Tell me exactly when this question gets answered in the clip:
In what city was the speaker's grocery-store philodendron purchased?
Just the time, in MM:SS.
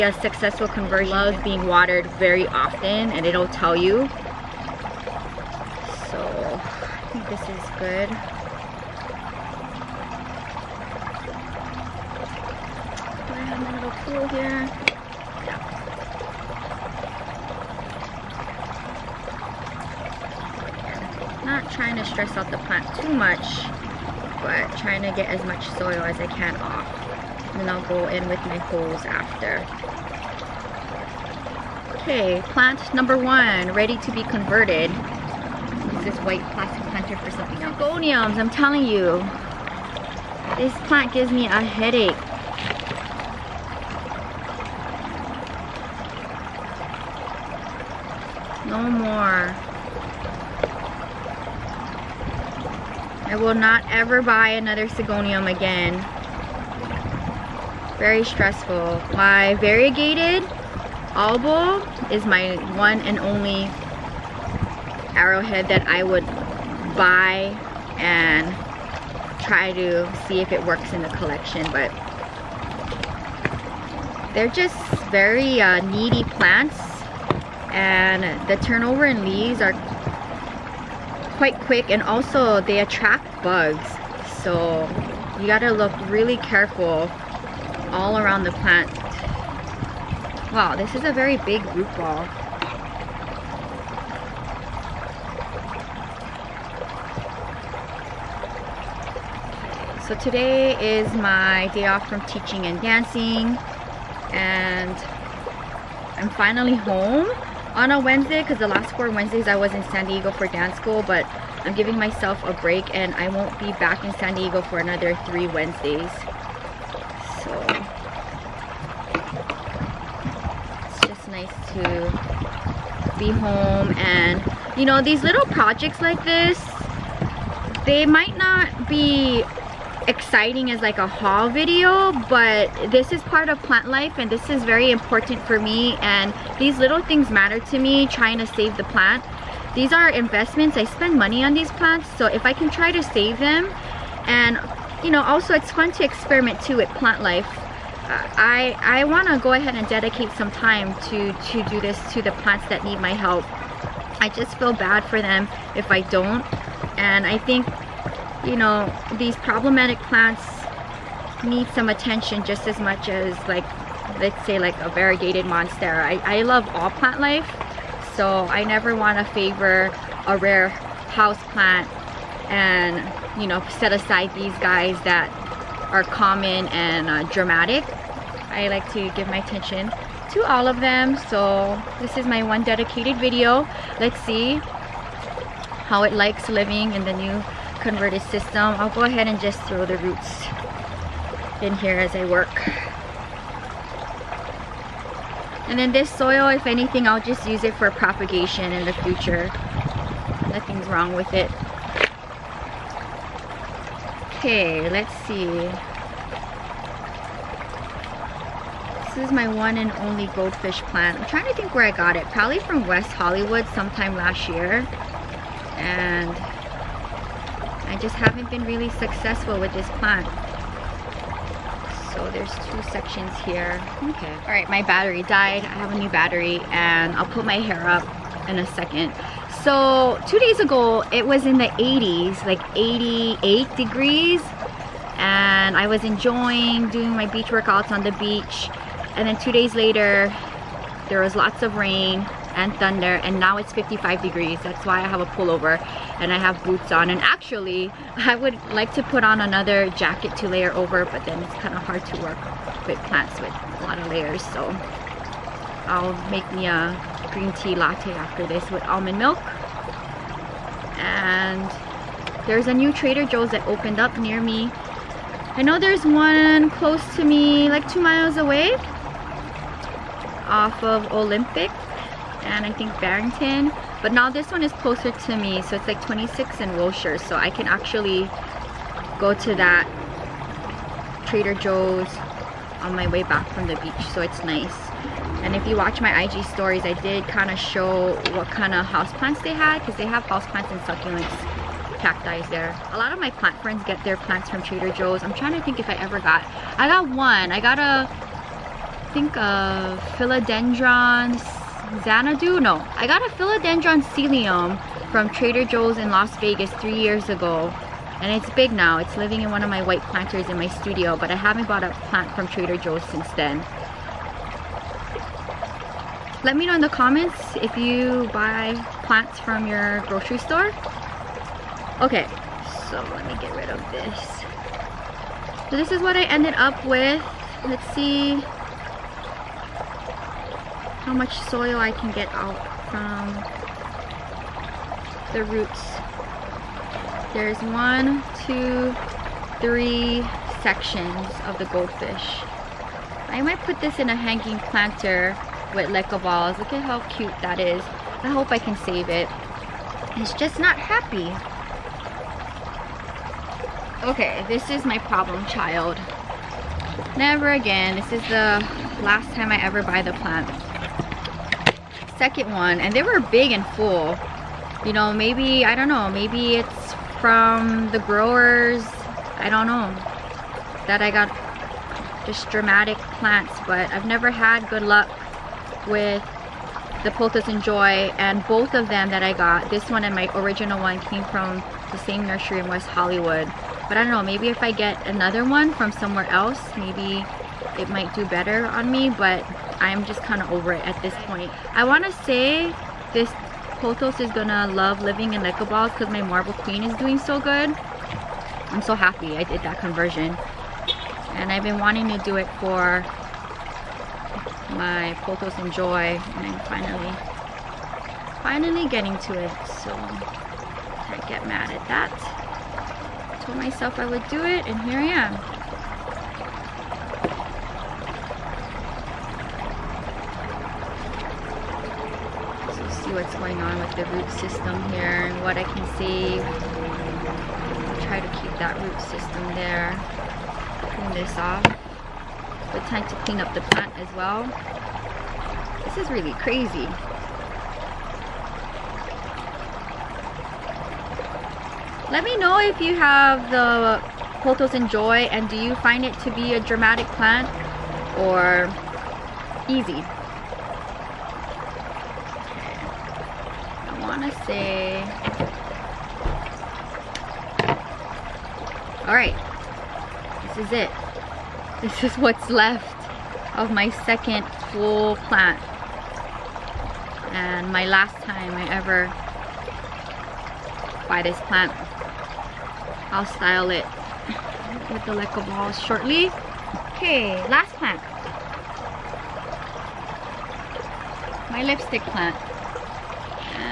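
05:06.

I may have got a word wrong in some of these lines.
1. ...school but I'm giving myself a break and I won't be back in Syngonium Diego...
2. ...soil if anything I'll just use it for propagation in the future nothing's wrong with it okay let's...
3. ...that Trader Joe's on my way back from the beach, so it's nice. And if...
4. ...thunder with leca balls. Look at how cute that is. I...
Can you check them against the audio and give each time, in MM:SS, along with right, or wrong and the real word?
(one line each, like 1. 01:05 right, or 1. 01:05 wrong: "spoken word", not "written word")
1. 01:50 wrong: "San", not "Syngonium"
2. 03:16 right
3. 04:39 right
4. 05:44 wrong: "planter", not "thunder".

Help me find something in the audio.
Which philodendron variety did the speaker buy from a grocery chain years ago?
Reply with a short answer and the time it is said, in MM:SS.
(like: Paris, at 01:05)
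Selloum, at 05:04.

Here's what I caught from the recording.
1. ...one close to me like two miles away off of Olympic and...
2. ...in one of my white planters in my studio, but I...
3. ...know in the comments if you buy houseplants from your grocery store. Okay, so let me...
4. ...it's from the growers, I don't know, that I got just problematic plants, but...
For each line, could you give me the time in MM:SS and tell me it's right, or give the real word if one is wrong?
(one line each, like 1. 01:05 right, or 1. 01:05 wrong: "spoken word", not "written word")
1. 04:26 right
2. 05:09 right
3. 05:16 wrong: "plants", not "houseplants"
4. 06:06 wrong: "dramatic", not "problematic".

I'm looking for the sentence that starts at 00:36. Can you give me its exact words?
This white plastic planter for something else.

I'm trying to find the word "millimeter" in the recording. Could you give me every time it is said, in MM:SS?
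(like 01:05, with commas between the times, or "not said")
not said.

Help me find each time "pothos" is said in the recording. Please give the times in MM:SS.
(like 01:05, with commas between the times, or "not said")
06:33, 06:45, 07:24.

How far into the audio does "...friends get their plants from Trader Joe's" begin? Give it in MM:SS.
04:53.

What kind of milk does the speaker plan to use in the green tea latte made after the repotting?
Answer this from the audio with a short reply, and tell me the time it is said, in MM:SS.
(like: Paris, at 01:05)
Almond milk, at 04:18.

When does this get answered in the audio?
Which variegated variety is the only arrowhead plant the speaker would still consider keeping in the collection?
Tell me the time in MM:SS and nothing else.
01:01.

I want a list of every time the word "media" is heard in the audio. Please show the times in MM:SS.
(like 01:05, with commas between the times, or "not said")
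not said.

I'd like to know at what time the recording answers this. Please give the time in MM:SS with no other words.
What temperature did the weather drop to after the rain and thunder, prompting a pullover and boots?
04:03.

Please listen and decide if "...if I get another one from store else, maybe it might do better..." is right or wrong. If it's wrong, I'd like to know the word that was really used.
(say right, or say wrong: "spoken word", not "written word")
wrong: "somewhere", not "store".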